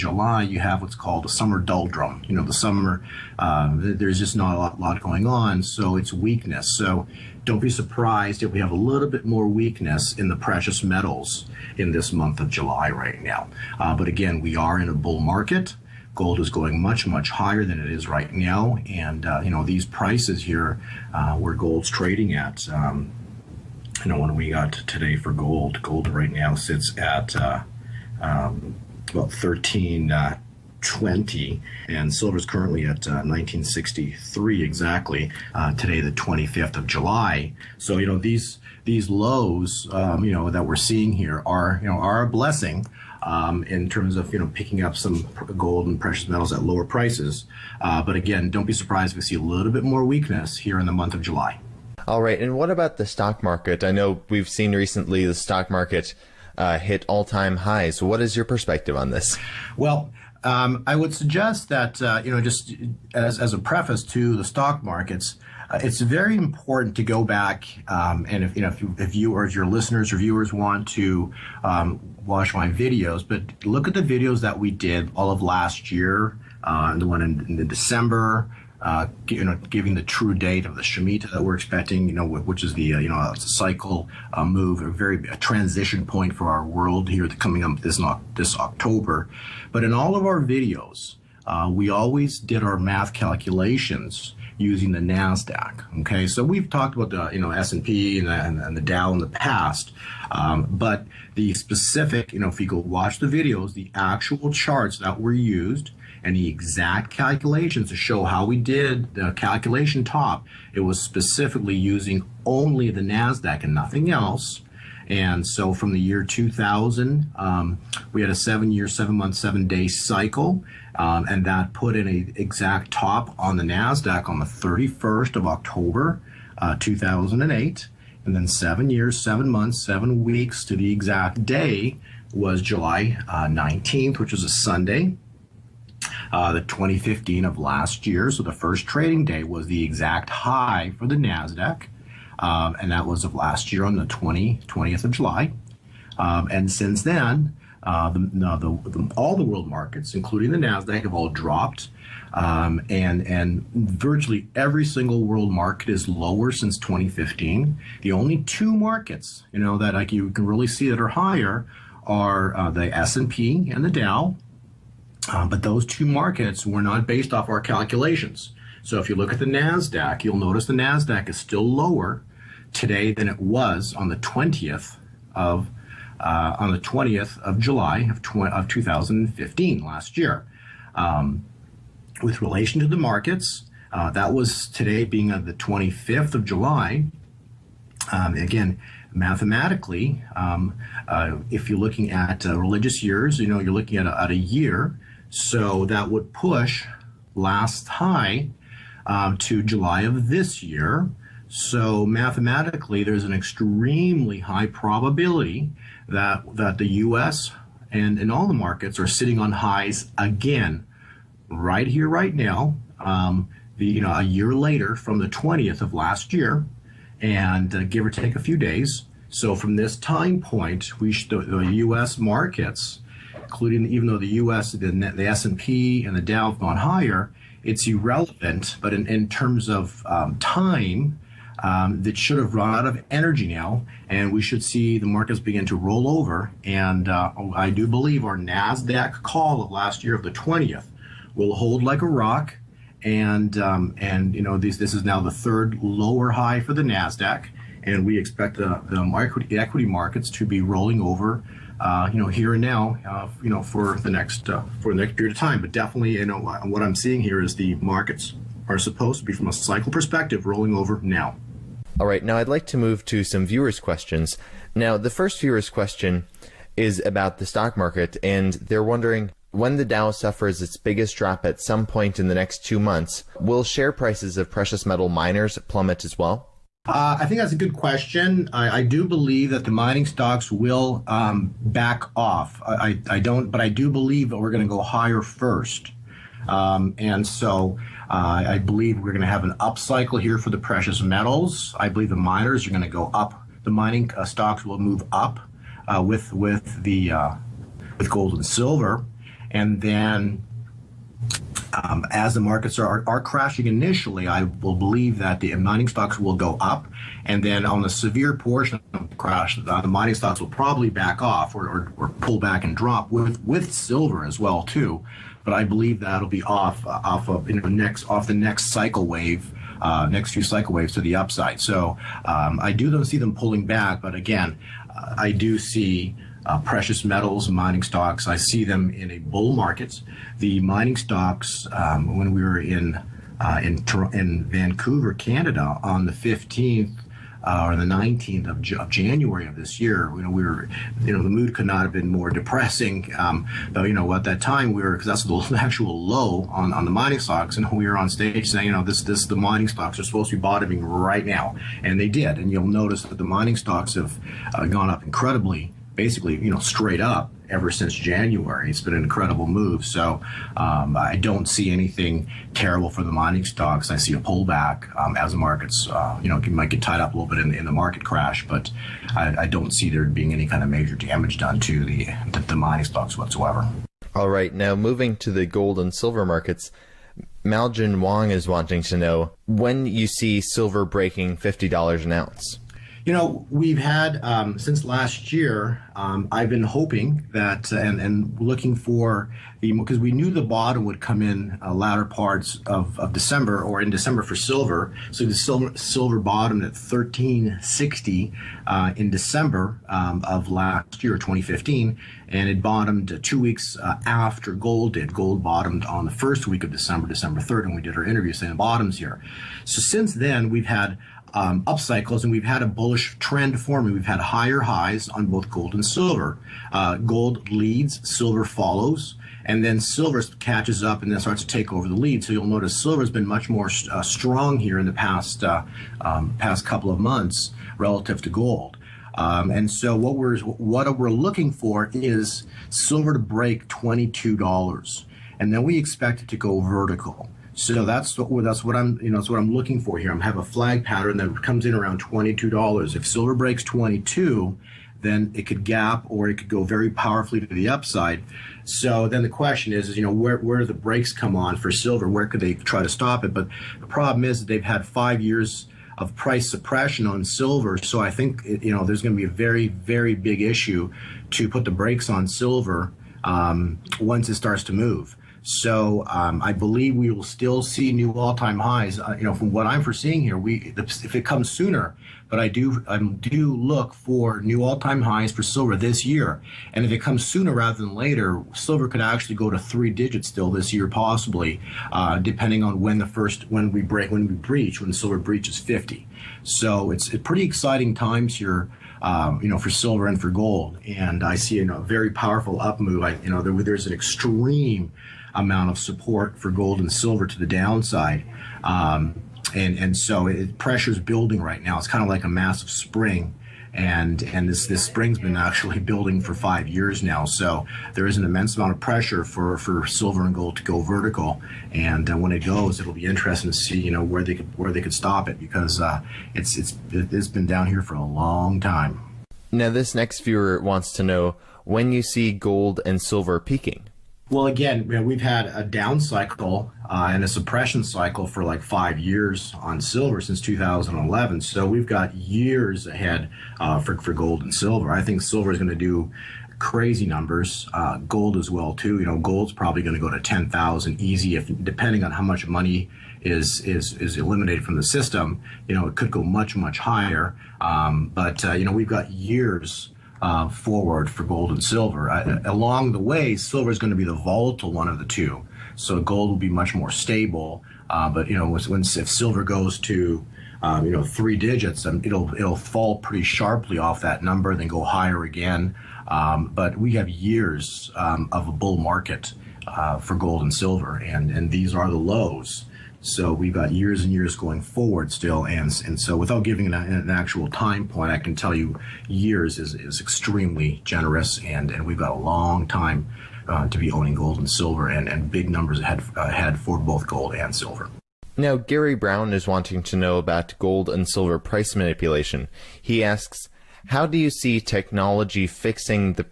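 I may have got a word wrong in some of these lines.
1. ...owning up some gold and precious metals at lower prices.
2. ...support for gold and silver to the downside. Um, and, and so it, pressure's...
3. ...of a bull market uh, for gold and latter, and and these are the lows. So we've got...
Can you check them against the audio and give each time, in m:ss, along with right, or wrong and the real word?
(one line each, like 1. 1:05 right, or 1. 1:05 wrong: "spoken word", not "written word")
1. 0:44 wrong: "picking", not "owning"
2. 8:15 right
3. 9:28 wrong: "silver", not "latter".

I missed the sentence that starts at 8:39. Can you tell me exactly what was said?
Now this next viewer wants to know when you see gold and silver peaking.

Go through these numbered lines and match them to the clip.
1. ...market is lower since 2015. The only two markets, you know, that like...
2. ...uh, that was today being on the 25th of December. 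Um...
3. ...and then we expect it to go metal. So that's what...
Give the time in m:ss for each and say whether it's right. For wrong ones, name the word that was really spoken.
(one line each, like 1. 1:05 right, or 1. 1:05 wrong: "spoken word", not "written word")
1. 2:35 right
2. 3:03 wrong: "July", not "December"
3. 7:15 wrong: "vertical", not "metal".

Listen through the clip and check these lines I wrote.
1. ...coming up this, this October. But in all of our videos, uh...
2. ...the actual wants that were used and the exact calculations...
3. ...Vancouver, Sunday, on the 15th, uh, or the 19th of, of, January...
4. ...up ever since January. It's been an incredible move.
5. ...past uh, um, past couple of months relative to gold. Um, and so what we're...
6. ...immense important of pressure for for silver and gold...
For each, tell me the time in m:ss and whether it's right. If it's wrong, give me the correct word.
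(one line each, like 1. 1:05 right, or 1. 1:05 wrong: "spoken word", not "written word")
1. 1:27 right
2. 1:43 wrong: "charts", not "wants"
3. 5:34 wrong: "Canada", not "Sunday"
4. 5:57 right
5. 7:04 right
6. 8:28 wrong: "amount", not "important".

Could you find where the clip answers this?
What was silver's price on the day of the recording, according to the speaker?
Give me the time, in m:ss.
0:33.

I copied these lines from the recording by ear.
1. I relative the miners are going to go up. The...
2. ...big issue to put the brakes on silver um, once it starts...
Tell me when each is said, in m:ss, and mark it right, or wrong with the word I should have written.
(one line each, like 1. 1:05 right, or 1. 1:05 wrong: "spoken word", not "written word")
1. 4:51 wrong: "believe", not "relative"
2. 7:40 right.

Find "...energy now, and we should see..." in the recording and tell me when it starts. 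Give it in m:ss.
3:53.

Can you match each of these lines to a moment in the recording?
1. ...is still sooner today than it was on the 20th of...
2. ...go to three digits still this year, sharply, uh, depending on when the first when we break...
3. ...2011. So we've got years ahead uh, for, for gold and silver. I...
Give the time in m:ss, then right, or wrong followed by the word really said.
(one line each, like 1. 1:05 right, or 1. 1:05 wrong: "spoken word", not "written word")
1. 2:51 wrong: "lower", not "sooner"
2. 7:59 wrong: "possibly", not "sharply"
3. 8:50 right.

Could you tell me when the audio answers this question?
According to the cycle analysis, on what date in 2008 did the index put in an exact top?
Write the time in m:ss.
2:04.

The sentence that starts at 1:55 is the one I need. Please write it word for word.
And so from the year 2000, um, we had a seven year, seven month, seven day cycle.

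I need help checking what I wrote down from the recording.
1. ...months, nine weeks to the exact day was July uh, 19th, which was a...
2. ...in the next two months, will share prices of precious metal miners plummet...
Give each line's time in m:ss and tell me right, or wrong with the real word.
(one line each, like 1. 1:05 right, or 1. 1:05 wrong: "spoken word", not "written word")
1. 2:09 wrong: "seven", not "nine"
2. 4:32 right.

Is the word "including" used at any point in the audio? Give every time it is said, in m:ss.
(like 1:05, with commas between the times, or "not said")
2:30, 3:43.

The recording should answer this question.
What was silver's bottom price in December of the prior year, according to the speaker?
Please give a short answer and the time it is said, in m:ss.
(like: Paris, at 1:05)
$13.60, at 6:36.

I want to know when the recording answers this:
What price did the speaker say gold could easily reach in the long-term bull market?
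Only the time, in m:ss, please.
9:00.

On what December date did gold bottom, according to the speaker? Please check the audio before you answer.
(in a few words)
December 3.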